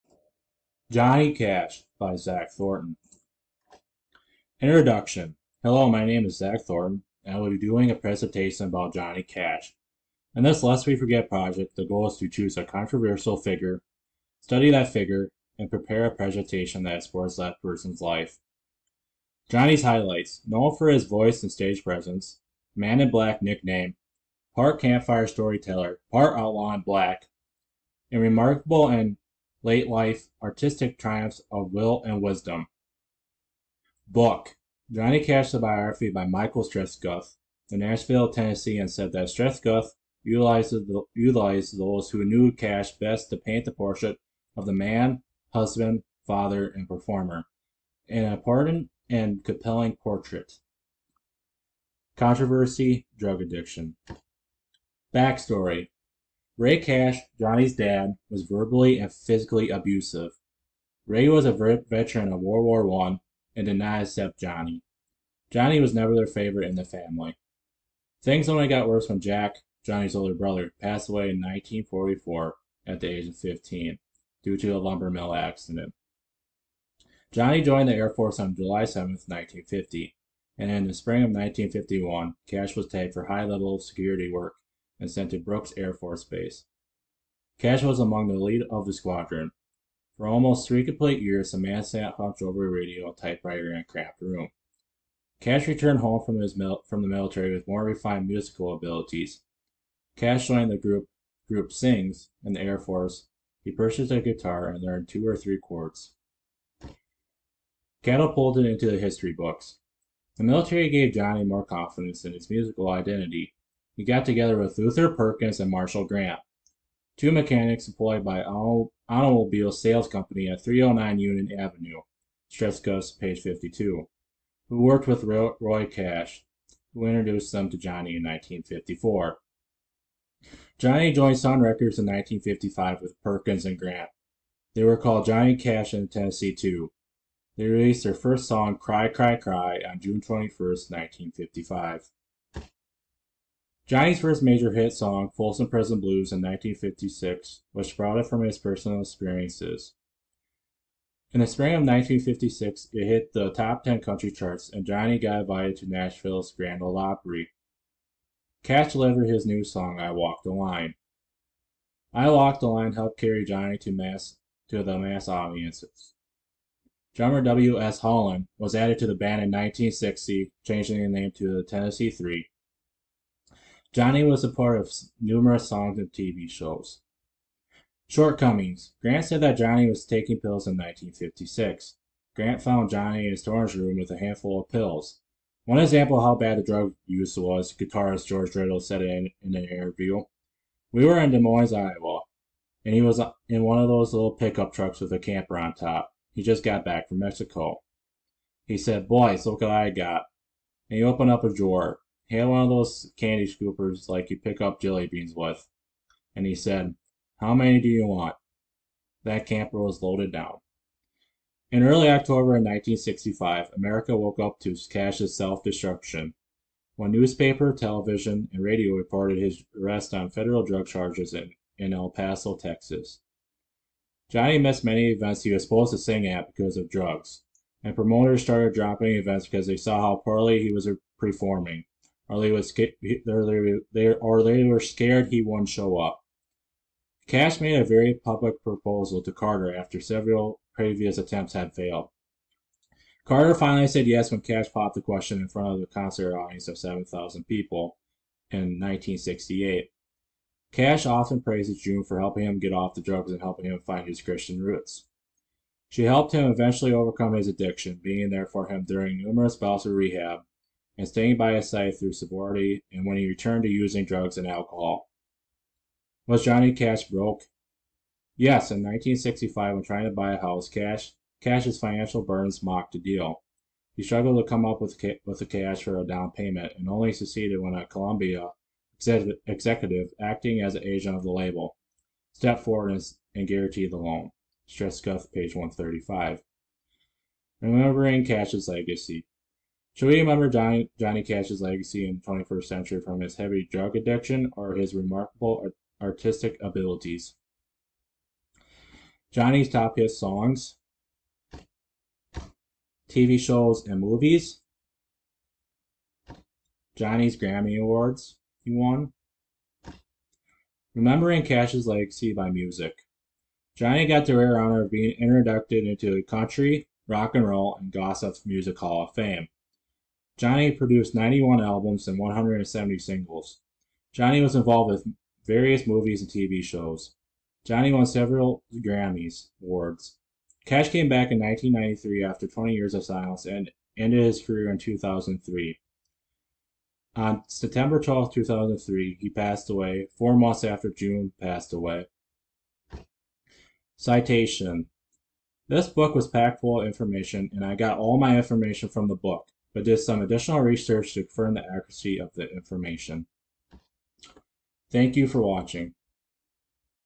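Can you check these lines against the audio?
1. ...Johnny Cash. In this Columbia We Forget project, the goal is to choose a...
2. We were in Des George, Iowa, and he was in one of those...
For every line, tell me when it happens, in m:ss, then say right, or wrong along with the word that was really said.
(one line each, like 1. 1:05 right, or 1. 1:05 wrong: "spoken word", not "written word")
1. 0:08 wrong: "Lest", not "Columbia"
2. 3:10 wrong: "Moines", not "George".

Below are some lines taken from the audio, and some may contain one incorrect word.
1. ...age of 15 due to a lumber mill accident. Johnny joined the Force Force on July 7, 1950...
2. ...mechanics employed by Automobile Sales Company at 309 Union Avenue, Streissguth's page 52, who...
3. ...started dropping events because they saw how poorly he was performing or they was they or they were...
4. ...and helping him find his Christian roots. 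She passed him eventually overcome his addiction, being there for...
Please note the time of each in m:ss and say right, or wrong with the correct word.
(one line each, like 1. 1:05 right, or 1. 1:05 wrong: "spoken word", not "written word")
1. 1:13 wrong: "Air", not "Force"
2. 1:57 right
3. 3:48 right
4. 4:13 wrong: "helped", not "passed".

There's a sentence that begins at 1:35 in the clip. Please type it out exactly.
Cash returned home from, his mil- from the military with more refined musical abilities.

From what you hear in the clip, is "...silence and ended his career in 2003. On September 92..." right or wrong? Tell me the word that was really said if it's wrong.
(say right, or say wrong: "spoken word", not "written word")
wrong: "12", not "92".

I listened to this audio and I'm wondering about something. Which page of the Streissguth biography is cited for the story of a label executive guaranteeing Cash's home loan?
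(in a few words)
135.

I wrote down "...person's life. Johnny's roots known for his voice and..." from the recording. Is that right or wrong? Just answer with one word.
wrong.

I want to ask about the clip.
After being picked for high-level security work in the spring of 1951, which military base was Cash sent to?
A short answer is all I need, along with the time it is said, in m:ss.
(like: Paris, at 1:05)
Brooks Air Force Base, at 1:25.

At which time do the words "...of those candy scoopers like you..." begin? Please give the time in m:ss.
3:22.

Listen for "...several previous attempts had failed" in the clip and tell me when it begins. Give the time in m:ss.
3:59.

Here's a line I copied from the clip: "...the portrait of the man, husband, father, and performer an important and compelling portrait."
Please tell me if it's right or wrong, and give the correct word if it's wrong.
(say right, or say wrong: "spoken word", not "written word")
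right.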